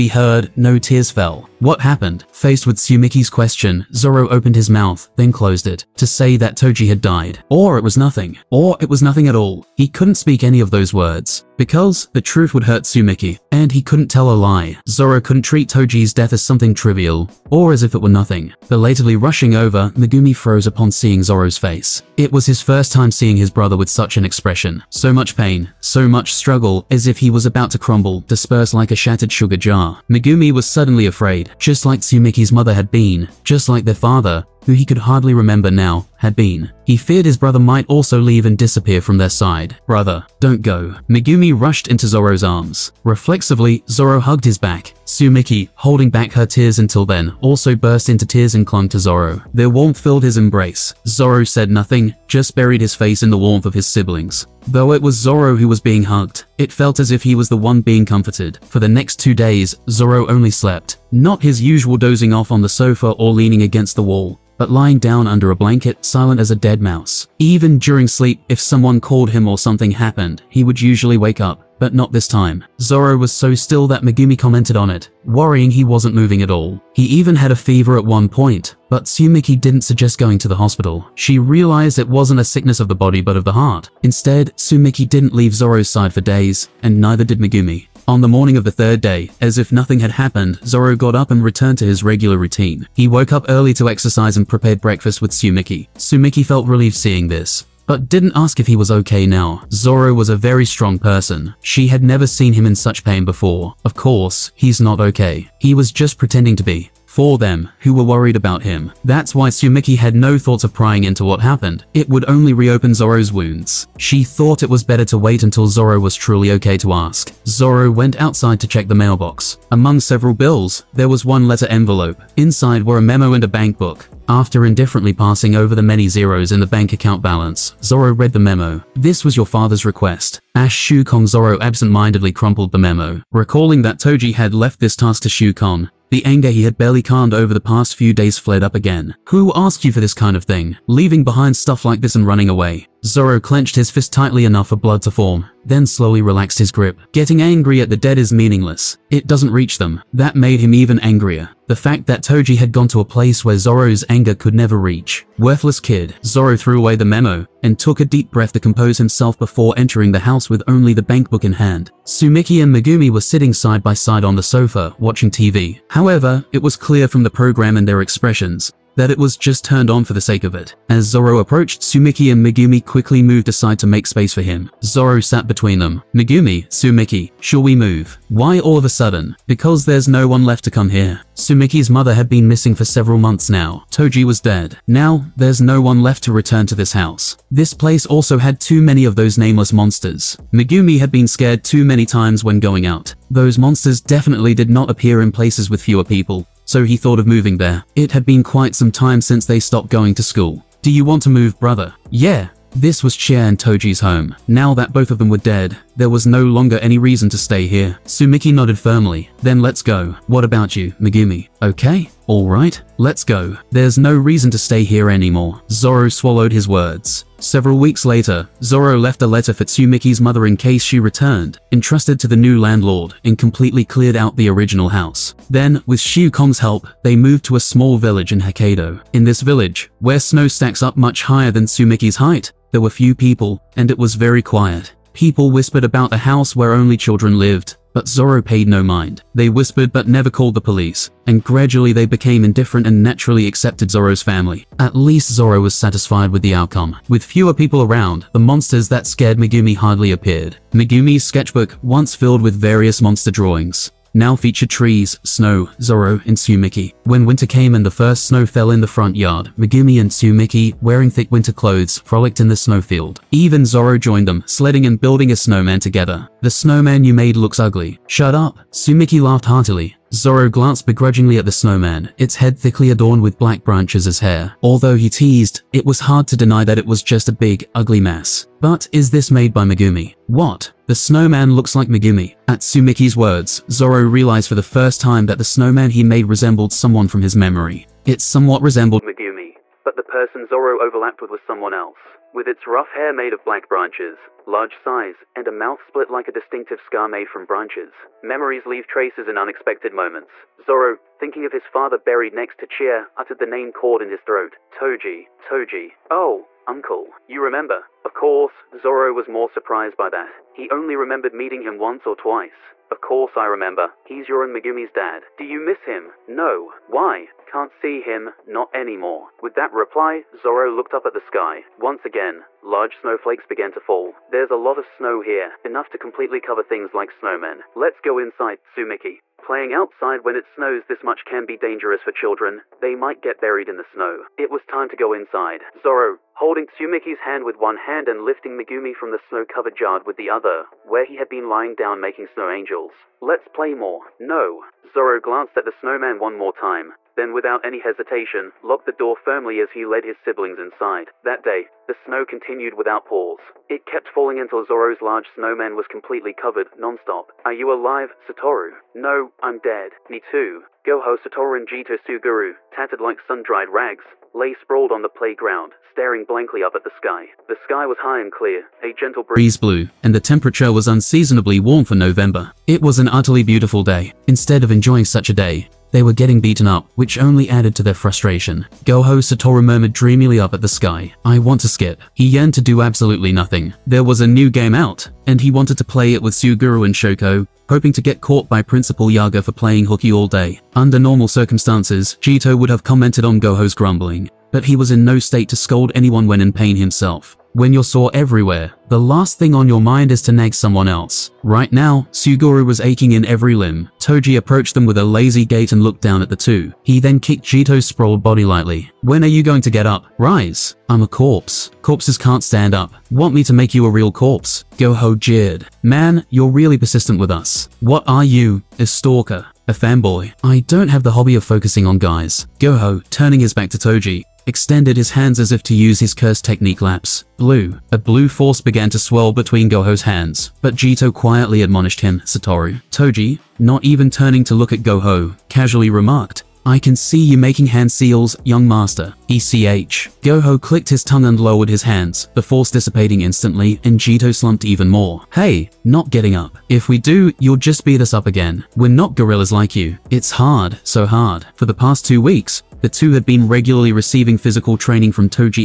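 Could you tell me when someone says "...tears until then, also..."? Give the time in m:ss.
0:46.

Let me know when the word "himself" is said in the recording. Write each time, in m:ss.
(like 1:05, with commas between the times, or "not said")
2:38, 6:36.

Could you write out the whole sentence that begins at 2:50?
As Zoro approached, Tsumiki and Megumi quickly moved aside to make space for him.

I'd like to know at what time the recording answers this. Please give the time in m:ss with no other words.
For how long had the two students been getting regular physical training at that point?
7:32.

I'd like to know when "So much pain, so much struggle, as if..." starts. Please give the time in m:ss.
0:24.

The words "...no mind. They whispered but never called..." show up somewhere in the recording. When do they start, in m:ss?
3:58.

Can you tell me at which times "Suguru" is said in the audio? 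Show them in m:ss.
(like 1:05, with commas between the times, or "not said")
6:01, 6:26, 6:42.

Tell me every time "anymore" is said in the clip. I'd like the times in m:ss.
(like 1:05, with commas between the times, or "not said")
3:35, 5:18.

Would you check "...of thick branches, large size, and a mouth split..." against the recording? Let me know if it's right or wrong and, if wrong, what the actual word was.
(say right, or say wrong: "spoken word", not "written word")
wrong: "black", not "thick".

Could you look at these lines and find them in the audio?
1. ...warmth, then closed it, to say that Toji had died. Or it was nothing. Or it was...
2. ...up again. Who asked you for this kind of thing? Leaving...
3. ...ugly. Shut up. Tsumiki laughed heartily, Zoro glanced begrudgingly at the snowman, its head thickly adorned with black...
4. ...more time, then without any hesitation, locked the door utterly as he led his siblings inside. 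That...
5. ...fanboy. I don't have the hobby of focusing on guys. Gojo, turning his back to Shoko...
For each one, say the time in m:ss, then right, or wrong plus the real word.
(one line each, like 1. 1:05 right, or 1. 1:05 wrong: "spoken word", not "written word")
1. 0:04 wrong: "mouth", not "warmth"
2. 2:18 right
3. 4:27 right
4. 5:46 wrong: "firmly", not "utterly"
5. 6:59 wrong: "Toji", not "Shoko".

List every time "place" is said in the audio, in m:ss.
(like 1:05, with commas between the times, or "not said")
2:33, 3:07, 3:15.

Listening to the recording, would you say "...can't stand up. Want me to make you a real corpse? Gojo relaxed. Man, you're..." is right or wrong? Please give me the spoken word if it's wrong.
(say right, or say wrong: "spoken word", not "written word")
wrong: "jeered", not "relaxed".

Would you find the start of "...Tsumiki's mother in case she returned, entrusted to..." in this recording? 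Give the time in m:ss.
3:39.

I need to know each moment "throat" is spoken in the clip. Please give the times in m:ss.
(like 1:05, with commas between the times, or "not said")
5:04.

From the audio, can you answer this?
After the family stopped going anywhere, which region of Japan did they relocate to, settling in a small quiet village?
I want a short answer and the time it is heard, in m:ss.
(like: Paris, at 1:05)
Hokkaido, at 3:48.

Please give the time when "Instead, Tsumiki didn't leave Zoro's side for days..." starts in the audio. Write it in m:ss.
1:24.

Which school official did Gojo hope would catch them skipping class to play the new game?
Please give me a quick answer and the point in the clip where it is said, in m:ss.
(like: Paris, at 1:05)
Principal Yaga, at 6:28.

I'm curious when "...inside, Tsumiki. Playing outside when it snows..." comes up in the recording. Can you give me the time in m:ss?
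5:28.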